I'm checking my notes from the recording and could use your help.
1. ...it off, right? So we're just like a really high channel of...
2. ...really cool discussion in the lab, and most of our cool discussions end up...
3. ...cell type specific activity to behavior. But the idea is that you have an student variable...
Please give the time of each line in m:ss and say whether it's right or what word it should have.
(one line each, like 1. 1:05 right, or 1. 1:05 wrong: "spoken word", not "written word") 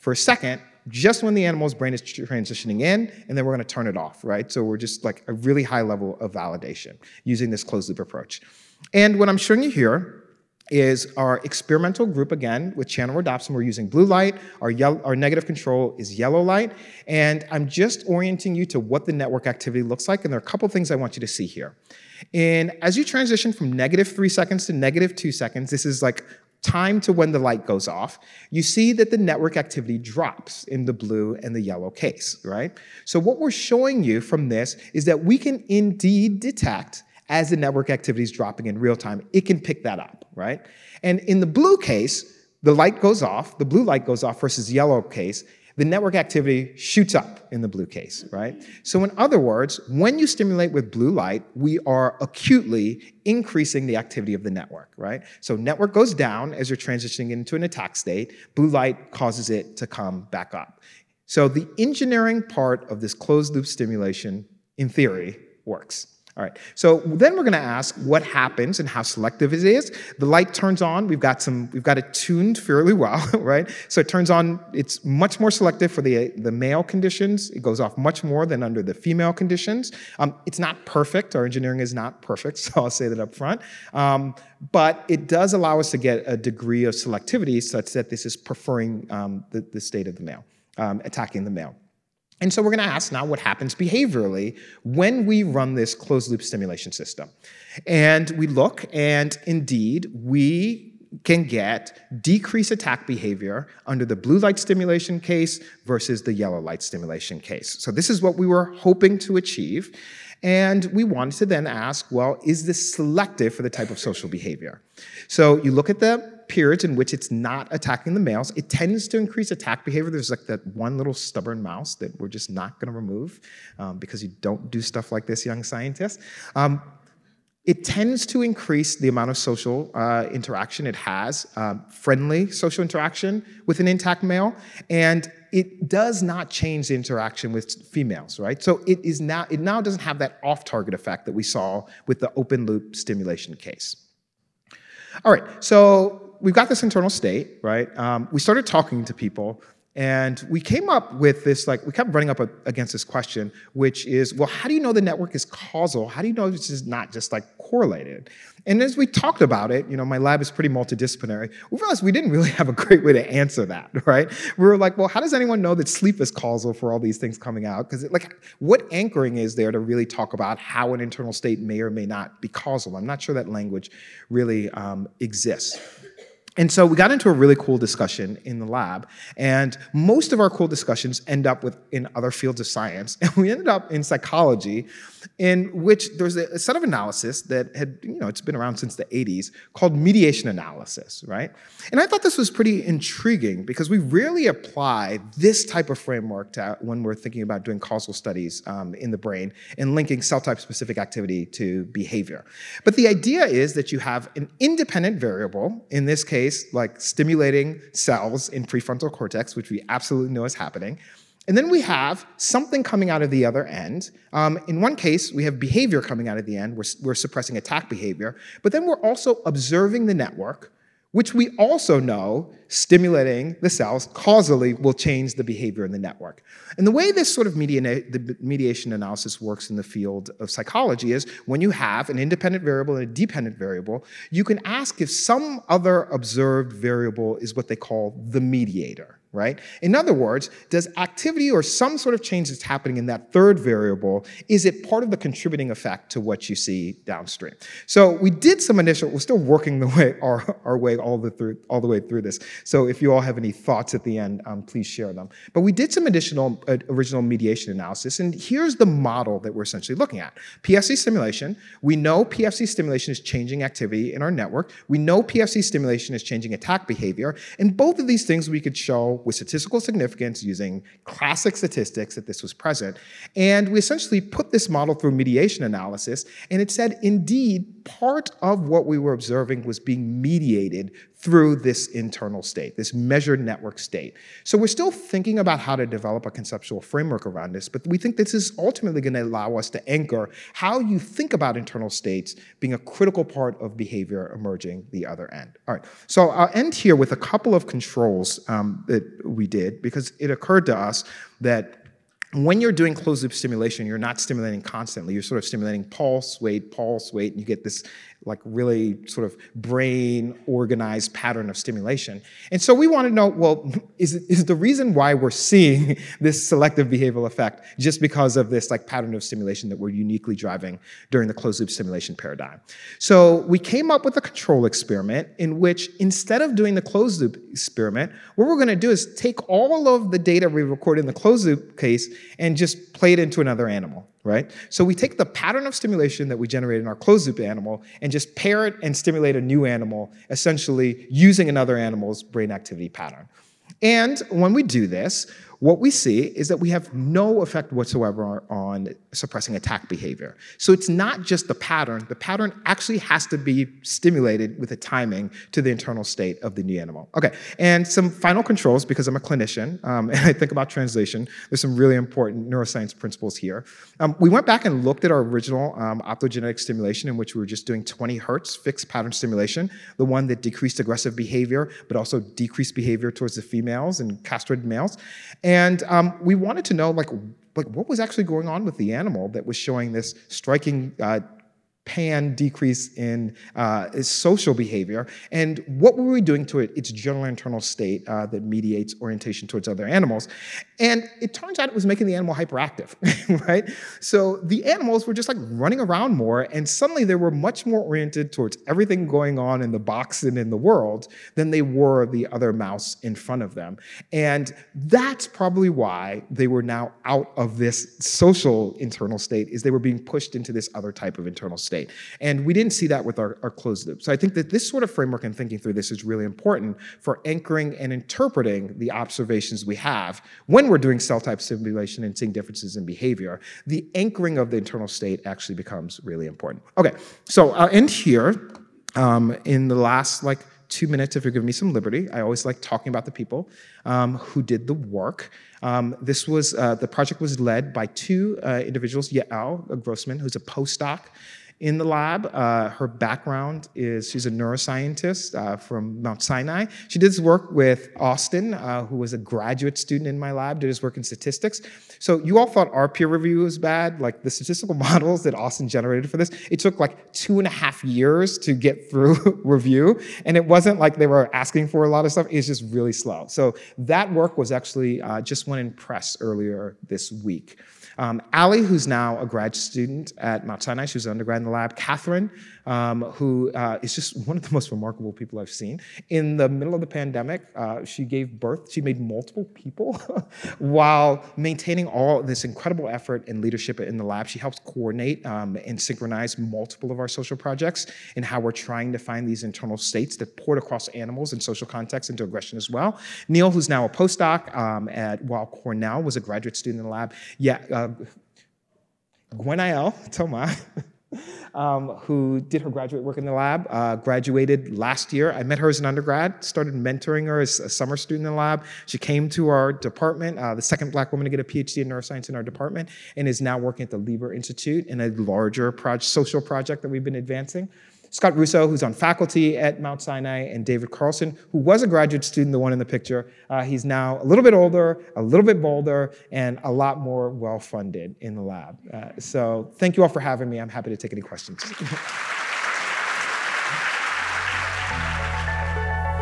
1. 0:03 wrong: "level", not "channel"
2. 2:57 right
3. 3:20 wrong: "independent", not "student".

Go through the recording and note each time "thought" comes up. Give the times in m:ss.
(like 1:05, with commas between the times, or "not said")
3:12, 4:13, 7:32.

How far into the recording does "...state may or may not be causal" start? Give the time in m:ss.
2:51.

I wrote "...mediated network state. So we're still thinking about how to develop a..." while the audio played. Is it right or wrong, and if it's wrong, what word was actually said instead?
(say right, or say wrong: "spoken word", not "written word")
wrong: "measured", not "mediated".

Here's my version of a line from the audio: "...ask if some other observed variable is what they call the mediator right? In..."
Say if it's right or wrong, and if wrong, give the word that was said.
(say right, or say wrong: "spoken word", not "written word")
right.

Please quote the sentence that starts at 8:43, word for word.
Uh, he's now a little bit older, a little bit bolder, and a lot more well funded in the lab.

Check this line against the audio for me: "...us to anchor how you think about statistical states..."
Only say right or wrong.
wrong.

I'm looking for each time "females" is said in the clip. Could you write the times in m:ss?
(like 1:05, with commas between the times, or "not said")
1:18, 2:17, 6:13.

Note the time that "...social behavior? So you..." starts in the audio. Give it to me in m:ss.
1:53.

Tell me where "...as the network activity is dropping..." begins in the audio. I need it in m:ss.
0:37.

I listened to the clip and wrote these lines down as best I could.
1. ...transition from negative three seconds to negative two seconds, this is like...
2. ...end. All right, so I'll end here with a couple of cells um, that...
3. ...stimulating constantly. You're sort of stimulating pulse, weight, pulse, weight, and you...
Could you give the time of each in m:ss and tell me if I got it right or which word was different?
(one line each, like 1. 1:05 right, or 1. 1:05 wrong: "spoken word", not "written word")
1. 0:23 right
2. 4:55 wrong: "controls", not "cells"
3. 5:04 right.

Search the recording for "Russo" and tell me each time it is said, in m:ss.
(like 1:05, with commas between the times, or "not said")
8:38.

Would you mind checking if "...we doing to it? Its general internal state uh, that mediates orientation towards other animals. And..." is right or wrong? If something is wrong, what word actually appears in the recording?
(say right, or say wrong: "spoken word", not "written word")
right.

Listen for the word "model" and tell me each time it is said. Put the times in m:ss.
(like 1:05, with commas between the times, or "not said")
4:18, 4:34, 7:34.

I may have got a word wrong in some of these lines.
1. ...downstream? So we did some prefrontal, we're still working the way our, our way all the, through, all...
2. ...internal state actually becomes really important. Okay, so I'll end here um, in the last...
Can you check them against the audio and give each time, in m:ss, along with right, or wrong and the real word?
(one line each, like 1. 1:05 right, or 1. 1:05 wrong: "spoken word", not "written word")
1. 4:07 wrong: "initial", not "prefrontal"
2. 7:04 right.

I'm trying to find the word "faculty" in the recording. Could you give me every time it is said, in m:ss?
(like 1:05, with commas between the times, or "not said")
8:38.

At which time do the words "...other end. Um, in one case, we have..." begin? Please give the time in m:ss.
3:33.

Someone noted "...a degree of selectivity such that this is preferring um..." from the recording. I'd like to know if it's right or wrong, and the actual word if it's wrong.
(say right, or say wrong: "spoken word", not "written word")
right.